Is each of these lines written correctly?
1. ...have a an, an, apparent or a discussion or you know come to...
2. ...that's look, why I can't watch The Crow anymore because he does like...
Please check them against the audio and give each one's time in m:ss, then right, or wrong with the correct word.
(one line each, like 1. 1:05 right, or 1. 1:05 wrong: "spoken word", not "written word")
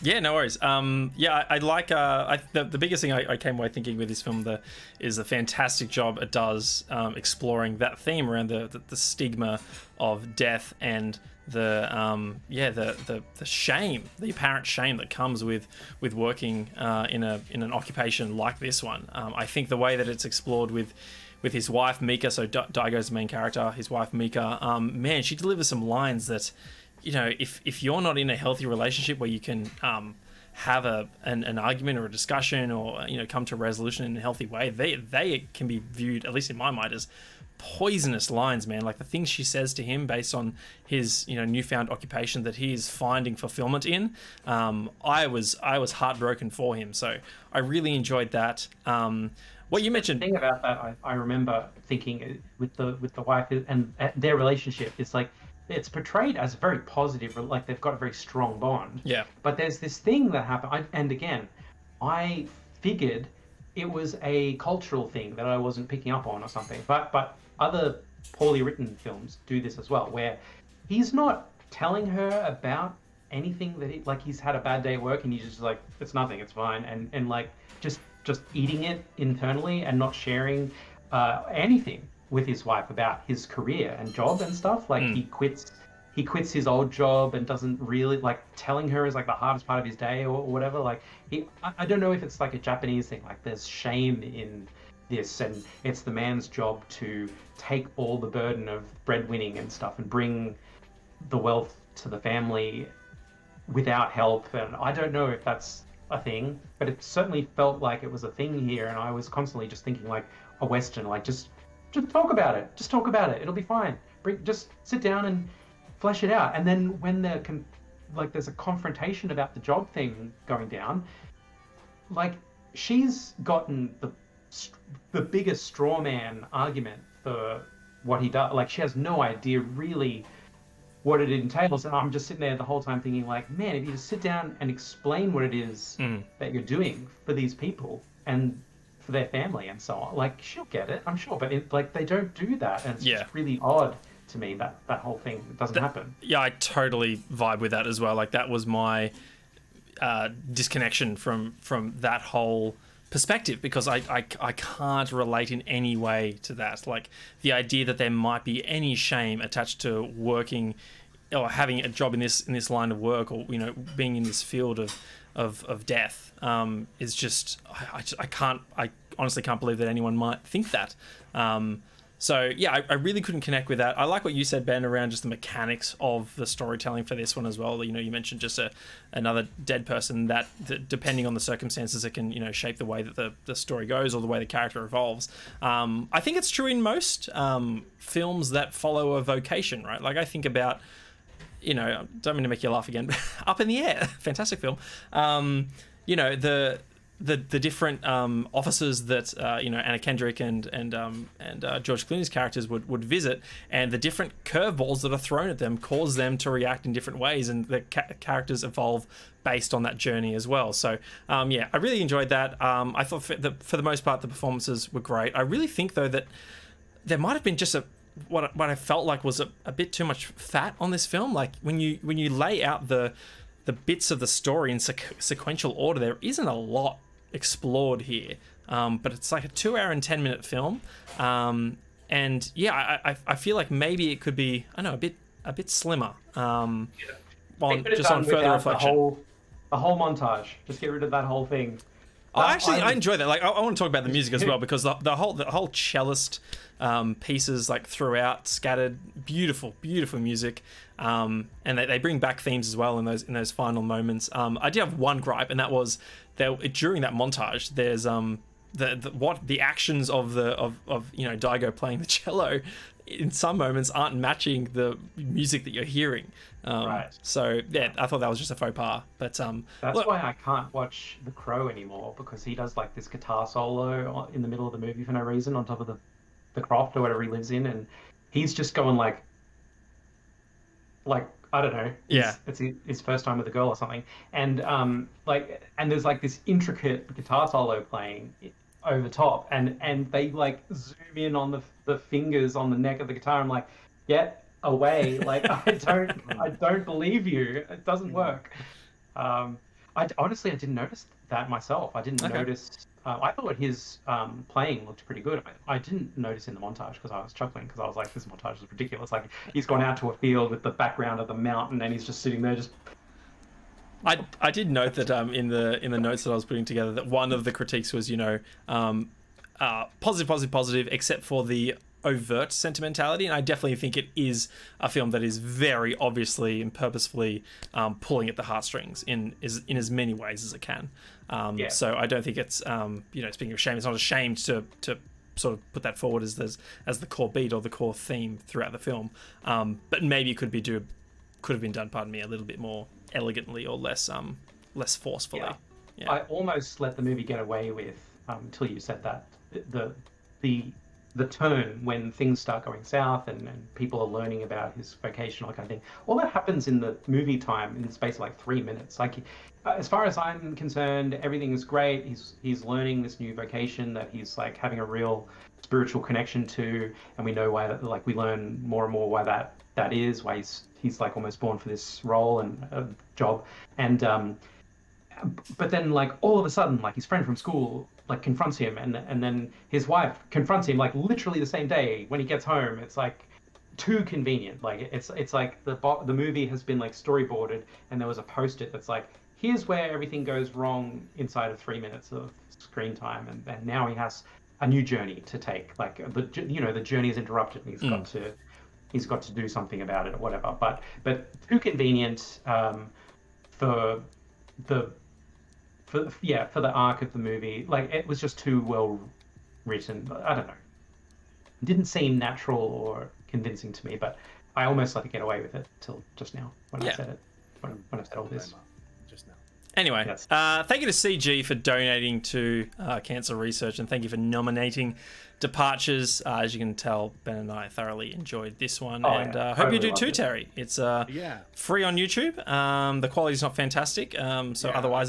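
1. 0:30 wrong: "argument", not "apparent"
2. 4:29 right.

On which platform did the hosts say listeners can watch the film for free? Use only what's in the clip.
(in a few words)
YouTube.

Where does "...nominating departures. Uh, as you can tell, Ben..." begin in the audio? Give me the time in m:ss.
7:04.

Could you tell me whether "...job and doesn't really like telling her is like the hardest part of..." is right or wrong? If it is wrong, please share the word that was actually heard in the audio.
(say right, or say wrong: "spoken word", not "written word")
right.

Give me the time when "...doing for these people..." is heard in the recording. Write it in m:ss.
2:16.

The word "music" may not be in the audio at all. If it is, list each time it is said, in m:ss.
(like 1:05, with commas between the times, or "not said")
4:04, 4:10, 4:25.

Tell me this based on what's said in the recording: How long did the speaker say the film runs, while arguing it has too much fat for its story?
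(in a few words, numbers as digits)
2 hours 10 minutes.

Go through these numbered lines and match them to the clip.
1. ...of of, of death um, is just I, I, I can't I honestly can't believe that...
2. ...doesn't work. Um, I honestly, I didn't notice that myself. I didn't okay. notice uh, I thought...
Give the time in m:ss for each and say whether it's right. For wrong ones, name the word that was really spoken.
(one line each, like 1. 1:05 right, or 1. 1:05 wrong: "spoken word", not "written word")
1. 2:44 right
2. 4:57 right.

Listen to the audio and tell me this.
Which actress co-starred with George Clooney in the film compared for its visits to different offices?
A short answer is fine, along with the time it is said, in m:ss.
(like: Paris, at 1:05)
Anna Kendrick, at 3:19.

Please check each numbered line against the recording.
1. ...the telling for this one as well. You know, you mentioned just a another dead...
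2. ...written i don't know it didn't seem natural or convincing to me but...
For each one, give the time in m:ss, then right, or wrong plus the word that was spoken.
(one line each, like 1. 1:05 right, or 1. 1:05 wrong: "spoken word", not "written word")
1. 2:56 wrong: "storytelling", not "telling"
2. 6:49 right.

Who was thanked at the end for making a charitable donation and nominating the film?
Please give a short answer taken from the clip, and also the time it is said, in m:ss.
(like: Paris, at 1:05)
CG, at 7:00.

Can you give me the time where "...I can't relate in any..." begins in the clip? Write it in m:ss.
2:34.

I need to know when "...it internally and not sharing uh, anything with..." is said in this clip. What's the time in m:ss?
1:18.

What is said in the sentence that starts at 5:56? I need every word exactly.
All that happens in the movie time in the space of like three minutes.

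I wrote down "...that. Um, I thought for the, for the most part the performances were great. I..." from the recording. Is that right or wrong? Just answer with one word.
right.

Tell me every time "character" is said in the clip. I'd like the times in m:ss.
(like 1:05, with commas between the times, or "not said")
0:23, 3:04, 3:22, 3:28.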